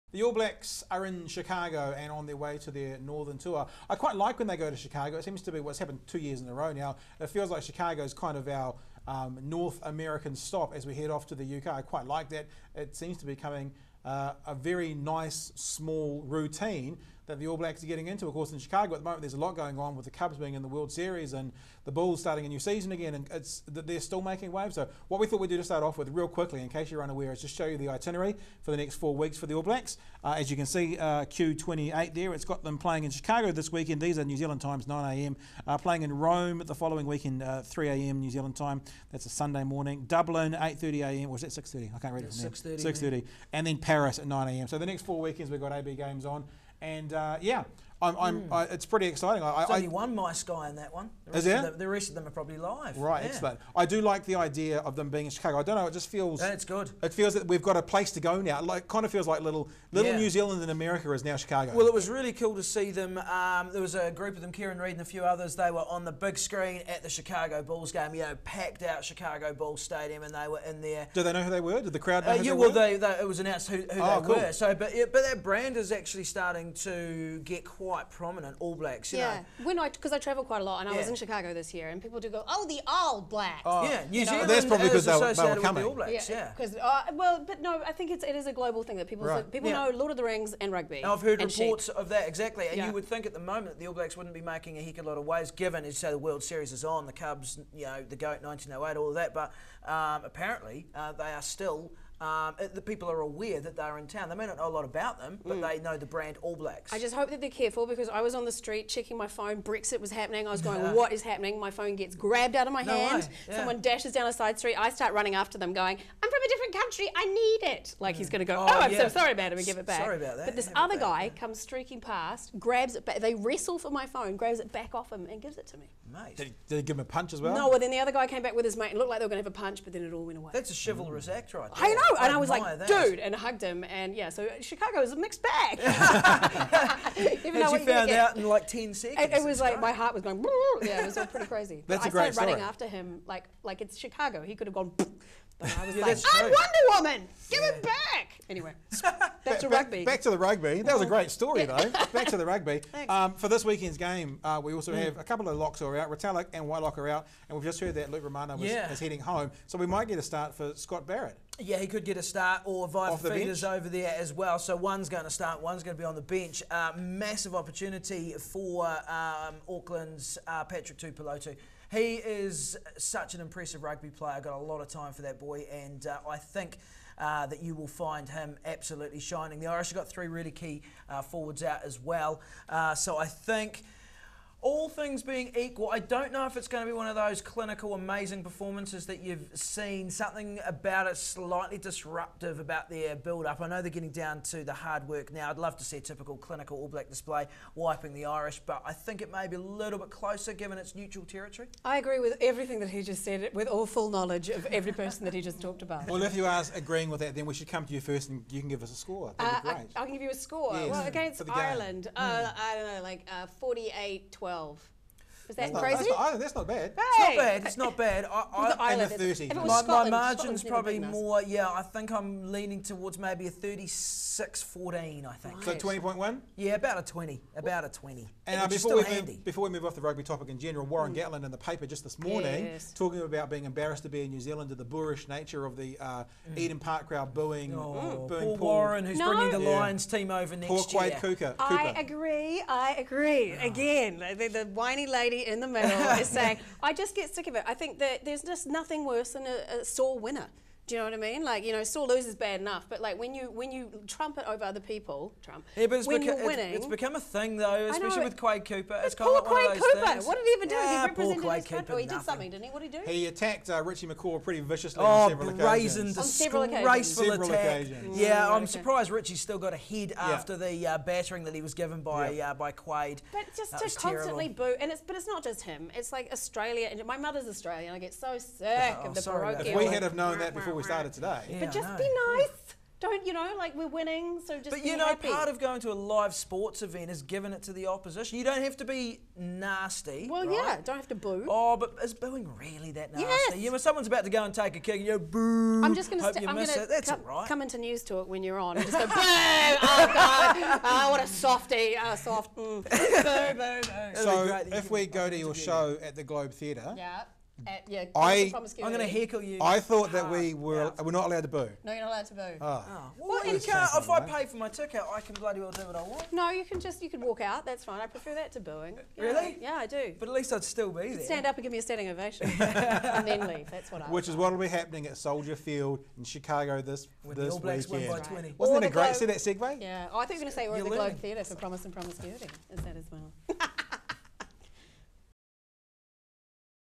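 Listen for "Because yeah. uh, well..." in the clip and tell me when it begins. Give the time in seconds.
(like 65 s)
86 s.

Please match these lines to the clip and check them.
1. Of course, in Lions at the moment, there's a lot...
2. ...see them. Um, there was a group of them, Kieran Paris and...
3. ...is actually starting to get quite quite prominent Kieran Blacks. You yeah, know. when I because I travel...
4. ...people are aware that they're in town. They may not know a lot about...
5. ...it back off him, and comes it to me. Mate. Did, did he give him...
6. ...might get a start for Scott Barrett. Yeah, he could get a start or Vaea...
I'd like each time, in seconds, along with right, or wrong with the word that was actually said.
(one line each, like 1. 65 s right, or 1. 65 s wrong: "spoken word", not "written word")
1. 18 s wrong: "Chicago", not "Lions"
2. 62 s wrong: "Read", not "Paris"
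3. 75 s wrong: "All", not "Kieran"
4. 102 s right
5. 124 s wrong: "gives", not "comes"
6. 159 s right.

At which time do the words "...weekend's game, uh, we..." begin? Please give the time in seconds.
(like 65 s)
153 s.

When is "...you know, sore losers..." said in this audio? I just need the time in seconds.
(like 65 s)
251 s.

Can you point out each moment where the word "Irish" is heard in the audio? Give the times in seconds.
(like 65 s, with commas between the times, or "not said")
179 s, 198 s.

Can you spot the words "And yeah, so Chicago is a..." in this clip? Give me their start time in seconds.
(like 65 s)
133 s.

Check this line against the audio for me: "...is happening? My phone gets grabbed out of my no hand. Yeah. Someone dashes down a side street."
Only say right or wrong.
right.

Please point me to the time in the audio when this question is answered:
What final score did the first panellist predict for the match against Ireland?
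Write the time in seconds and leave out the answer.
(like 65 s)
213 s.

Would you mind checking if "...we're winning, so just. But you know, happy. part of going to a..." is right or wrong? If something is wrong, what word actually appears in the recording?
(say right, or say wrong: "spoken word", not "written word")
right.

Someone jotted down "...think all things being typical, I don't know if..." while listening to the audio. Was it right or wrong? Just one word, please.
wrong.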